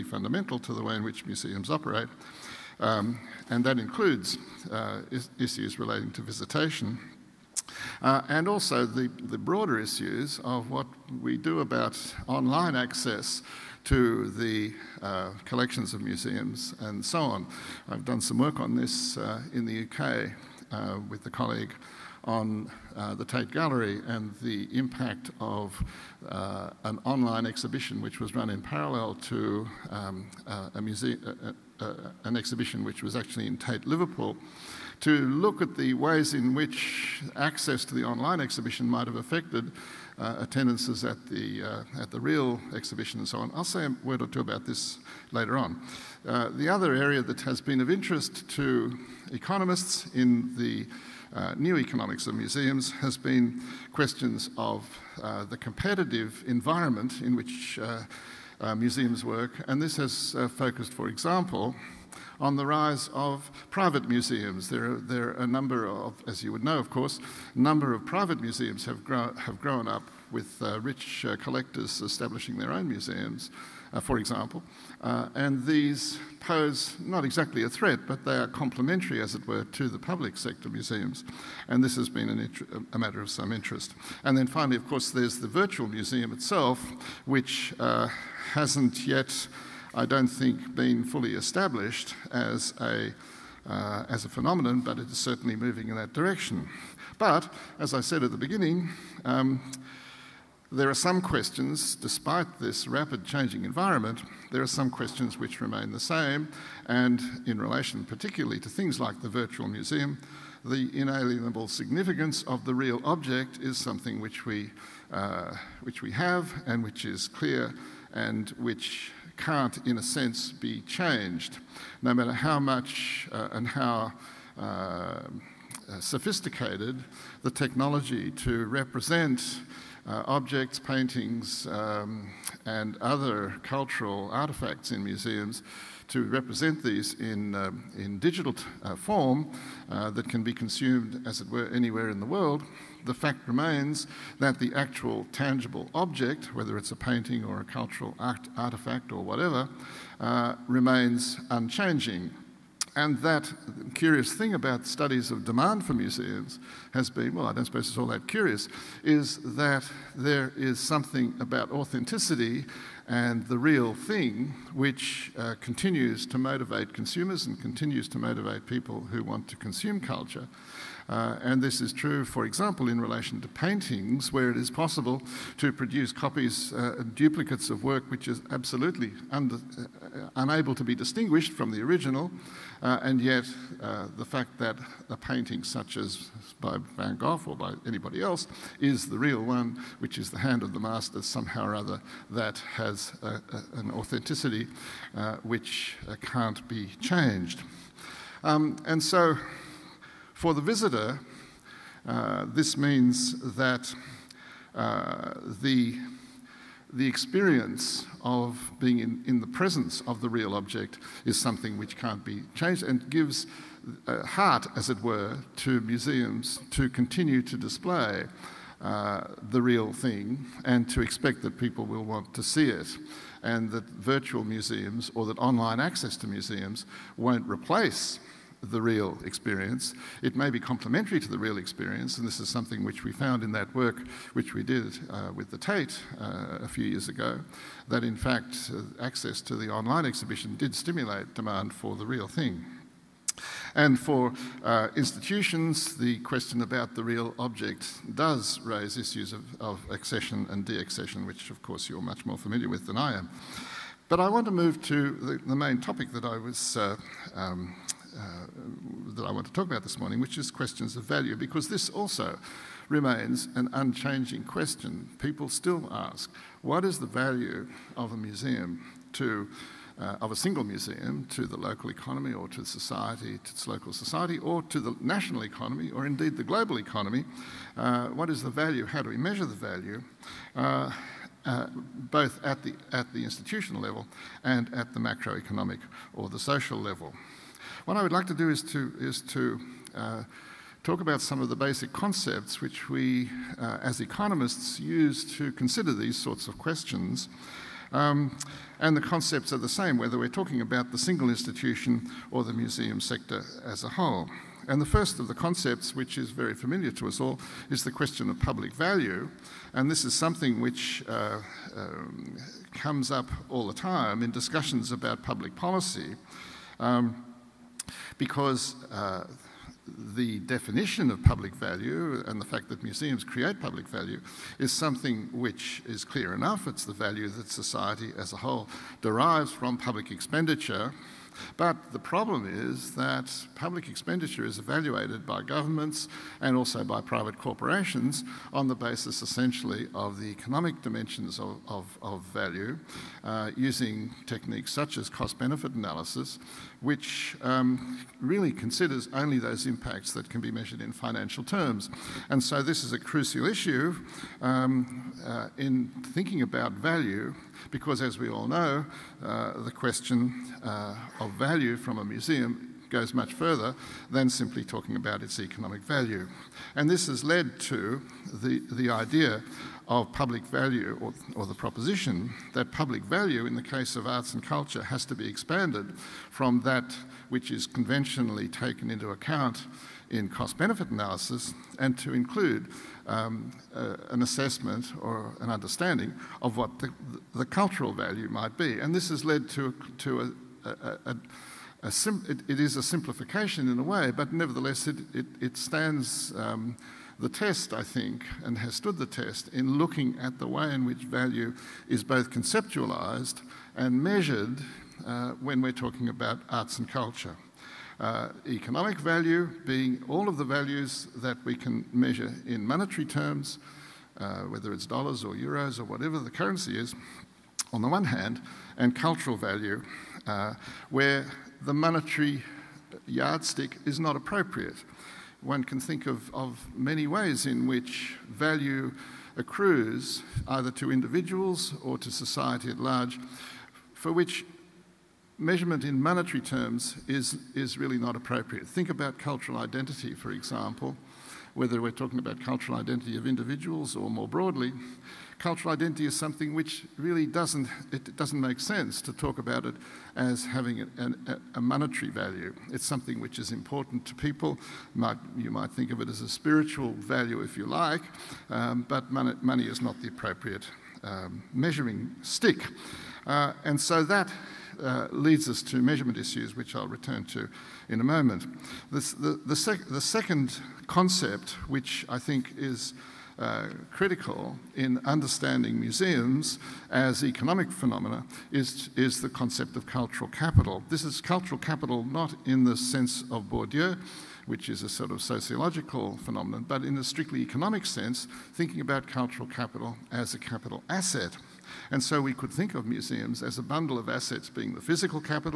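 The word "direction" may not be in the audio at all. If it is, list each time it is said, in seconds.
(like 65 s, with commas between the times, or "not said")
96 s.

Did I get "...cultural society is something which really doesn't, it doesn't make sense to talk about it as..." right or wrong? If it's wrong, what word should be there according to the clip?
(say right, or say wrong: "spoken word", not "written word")
wrong: "identity", not "society".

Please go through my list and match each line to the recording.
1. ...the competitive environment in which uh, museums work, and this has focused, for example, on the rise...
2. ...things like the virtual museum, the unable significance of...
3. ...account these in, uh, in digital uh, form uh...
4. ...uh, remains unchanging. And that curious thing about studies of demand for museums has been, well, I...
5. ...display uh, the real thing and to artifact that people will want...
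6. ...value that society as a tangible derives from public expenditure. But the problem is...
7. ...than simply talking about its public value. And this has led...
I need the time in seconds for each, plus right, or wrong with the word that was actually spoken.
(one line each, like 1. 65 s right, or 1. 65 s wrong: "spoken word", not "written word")
1. 55 s right
2. 108 s wrong: "inalienable", not "unable"
3. 136 s wrong: "represent", not "account"
4. 150 s right
5. 217 s wrong: "expect", not "artifact"
6. 326 s wrong: "whole", not "tangible"
7. 364 s wrong: "economic", not "public".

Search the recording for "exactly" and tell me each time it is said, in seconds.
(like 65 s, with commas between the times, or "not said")
77 s.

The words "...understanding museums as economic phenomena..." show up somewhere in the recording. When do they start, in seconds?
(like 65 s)
475 s.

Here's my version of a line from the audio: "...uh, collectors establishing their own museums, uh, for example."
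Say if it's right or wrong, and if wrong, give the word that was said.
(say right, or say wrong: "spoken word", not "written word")
right.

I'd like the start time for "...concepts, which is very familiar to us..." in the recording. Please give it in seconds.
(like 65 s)
305 s.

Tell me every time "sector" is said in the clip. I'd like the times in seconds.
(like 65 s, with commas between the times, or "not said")
80 s, 302 s.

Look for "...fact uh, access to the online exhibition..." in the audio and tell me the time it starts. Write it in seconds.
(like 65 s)
238 s.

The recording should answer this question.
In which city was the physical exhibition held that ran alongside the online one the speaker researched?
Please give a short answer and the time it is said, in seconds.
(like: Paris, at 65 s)
Liverpool, at 33 s.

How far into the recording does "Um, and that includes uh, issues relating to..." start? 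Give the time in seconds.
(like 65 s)
2 s.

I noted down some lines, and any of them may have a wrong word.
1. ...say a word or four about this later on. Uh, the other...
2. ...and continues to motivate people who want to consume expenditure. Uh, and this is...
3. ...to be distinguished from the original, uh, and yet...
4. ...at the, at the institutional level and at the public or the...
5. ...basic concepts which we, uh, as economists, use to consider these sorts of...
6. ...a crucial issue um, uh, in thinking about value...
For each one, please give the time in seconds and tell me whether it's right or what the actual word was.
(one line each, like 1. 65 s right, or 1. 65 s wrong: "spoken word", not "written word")
1. 43 s wrong: "two", not "four"
2. 167 s wrong: "culture", not "expenditure"
3. 180 s right
4. 282 s wrong: "macroeconomic", not "public"
5. 291 s right
6. 352 s right.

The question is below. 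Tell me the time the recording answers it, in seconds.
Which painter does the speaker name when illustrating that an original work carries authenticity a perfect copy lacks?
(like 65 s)
186 s.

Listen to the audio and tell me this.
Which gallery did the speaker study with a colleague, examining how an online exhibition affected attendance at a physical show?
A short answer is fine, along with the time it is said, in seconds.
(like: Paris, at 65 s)
Tate Gallery, at 23 s.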